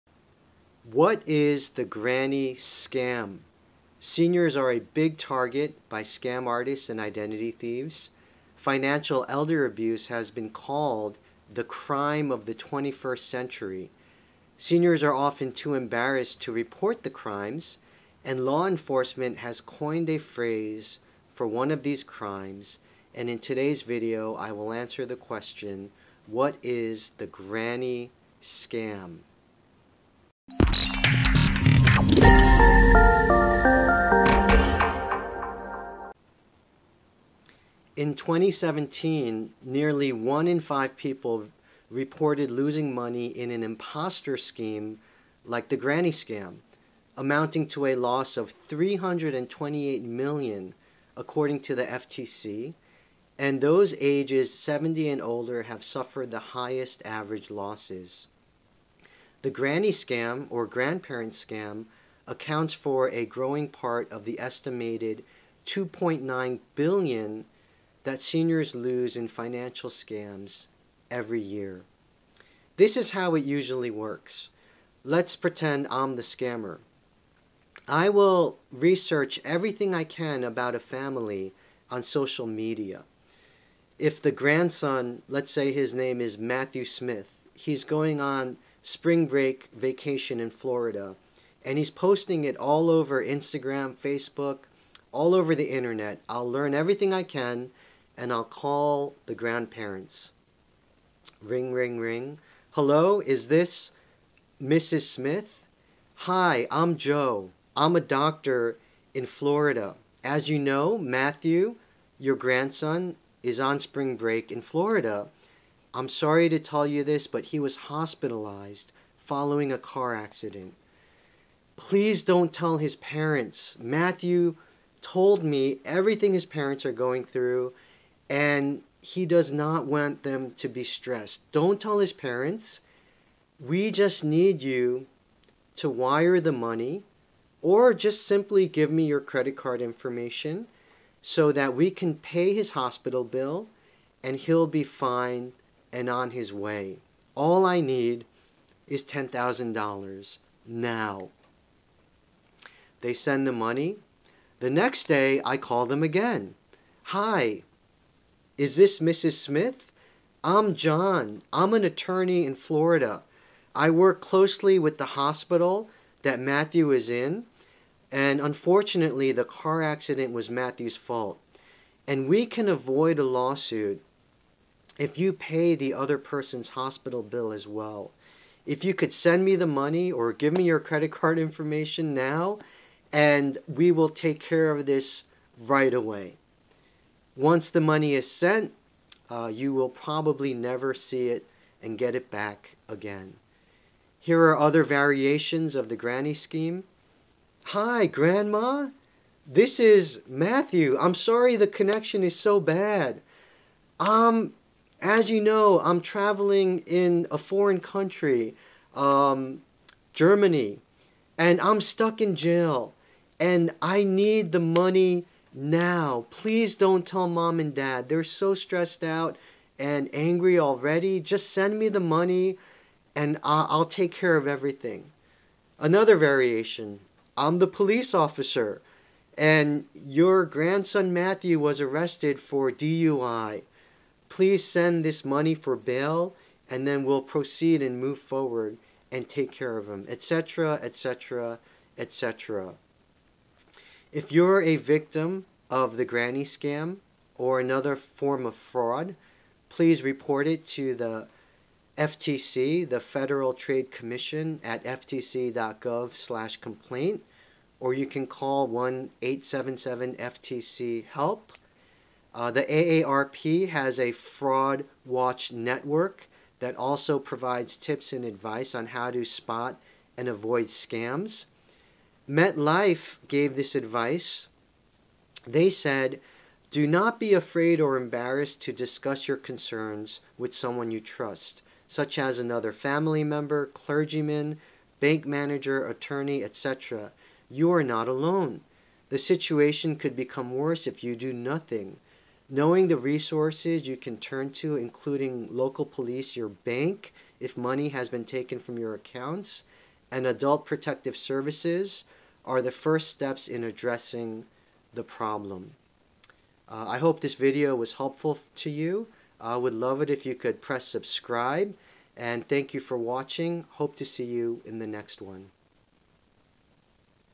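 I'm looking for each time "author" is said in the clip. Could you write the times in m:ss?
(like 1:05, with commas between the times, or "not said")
not said.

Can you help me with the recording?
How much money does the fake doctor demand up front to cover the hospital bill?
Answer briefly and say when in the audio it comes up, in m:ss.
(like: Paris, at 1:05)
$10,000, at 2:29.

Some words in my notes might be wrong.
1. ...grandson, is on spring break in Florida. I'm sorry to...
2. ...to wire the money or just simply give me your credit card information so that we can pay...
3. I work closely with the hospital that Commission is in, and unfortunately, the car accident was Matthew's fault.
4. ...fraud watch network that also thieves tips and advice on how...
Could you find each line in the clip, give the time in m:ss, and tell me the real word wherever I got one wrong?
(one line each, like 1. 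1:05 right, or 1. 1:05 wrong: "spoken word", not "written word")
1. 1:52 right
2. 2:15 right
3. 2:43 wrong: "Matthew", not "Commission"
4. 4:24 wrong: "provides", not "thieves".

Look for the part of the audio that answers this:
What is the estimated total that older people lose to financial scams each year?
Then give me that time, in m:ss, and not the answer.
1:05.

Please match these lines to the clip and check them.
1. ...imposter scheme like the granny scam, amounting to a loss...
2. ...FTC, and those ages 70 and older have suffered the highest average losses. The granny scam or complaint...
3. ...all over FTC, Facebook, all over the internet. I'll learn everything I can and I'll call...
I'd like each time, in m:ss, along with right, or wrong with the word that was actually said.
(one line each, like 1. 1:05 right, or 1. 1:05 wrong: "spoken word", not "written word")
1. 0:43 right
2. 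0:51 wrong: "grandparent", not "complaint"
3. 1:32 wrong: "Instagram", not "FTC".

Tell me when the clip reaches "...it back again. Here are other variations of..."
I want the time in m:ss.
3:12.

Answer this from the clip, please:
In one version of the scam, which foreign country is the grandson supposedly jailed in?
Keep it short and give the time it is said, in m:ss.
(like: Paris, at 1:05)
Germany, at 3:30.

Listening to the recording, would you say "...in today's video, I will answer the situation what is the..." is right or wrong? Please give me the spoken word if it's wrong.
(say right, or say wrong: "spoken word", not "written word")
wrong: "question", not "situation".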